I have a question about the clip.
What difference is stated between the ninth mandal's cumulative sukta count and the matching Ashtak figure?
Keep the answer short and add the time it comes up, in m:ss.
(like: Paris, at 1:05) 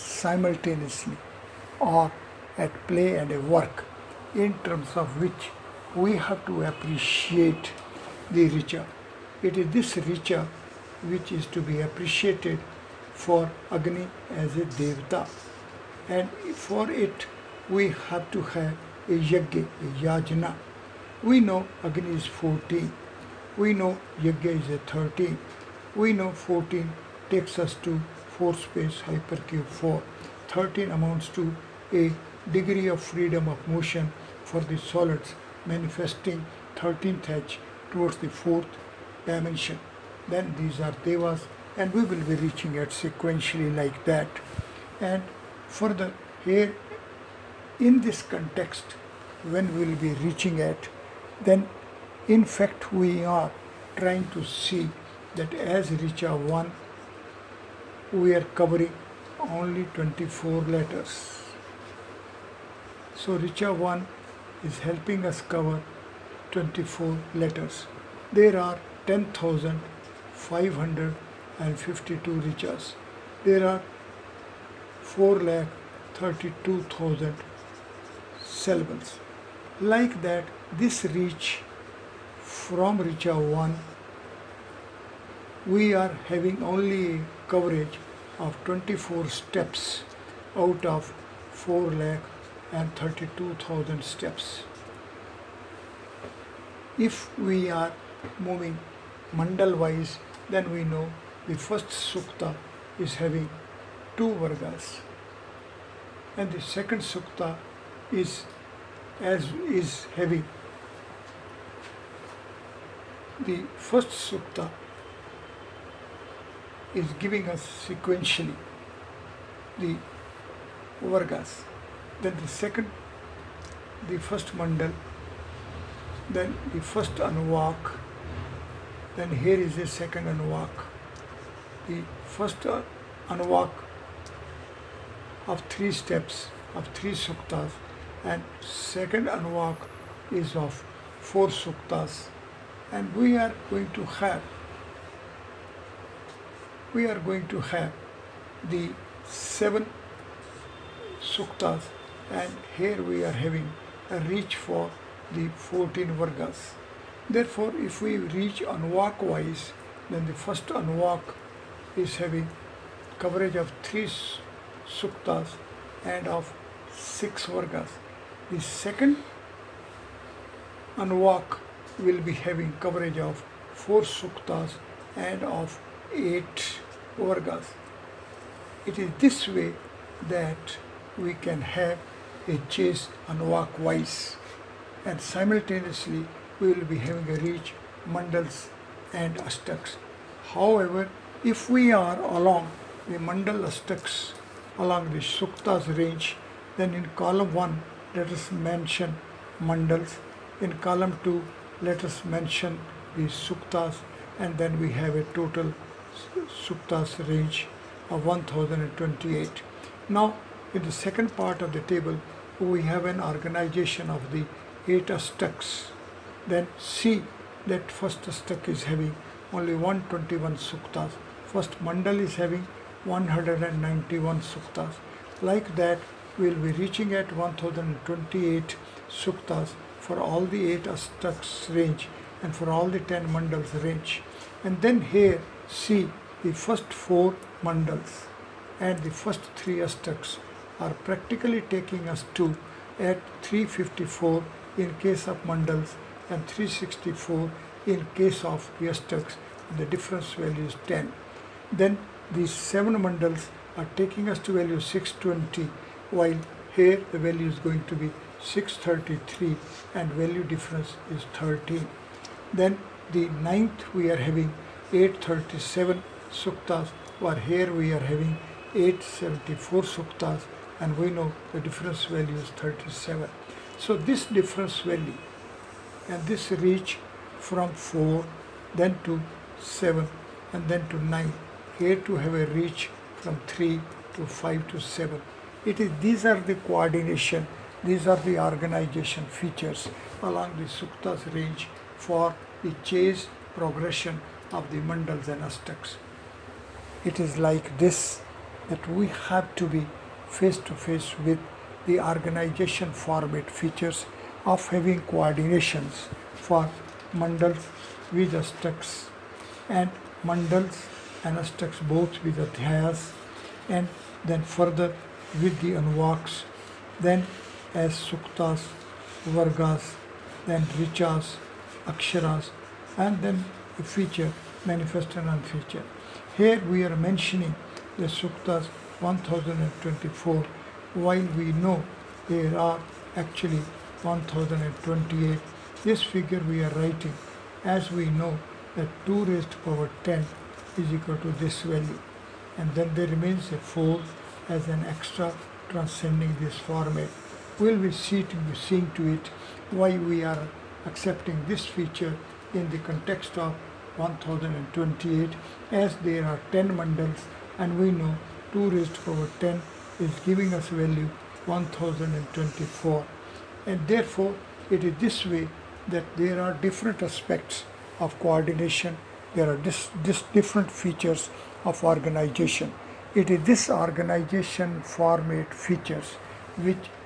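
37, at 4:32.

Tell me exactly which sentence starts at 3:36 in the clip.
Then see that first Ashtak is having only 121 suktas.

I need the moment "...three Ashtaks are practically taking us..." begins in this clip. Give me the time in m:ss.
3:59.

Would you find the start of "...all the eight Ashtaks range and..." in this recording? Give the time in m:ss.
3:50.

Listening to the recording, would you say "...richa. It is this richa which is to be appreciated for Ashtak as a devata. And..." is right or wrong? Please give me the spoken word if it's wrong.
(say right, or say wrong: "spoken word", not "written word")
wrong: "Agni", not "Ashtak".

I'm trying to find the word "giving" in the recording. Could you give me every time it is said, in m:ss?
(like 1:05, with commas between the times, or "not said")
1:57, 6:00.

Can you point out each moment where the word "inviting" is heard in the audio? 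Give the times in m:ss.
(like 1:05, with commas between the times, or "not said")
not said.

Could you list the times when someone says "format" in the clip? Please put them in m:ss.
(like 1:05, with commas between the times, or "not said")
5:02, 5:46, 6:14.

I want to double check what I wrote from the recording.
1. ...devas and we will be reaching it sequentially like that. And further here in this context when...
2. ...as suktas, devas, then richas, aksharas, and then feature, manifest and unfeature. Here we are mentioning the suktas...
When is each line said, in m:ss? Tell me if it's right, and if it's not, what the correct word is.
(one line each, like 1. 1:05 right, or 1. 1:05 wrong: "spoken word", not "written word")
1. 0:41 right
2. 5:17 wrong: "vargas", not "devas".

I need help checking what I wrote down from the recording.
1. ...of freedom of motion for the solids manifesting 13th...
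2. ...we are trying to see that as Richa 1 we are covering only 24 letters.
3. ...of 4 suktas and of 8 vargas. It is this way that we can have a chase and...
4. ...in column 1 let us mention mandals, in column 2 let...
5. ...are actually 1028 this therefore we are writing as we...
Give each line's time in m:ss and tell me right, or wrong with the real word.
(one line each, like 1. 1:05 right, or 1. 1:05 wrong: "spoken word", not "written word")
1. 0:32 right
2. 0:52 right
3. 2:53 right
4. 3:16 right
5. 5:32 wrong: "figure", not "therefore".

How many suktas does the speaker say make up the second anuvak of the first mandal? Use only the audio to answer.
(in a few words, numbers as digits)
4.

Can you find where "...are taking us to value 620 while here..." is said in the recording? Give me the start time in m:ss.
4:13.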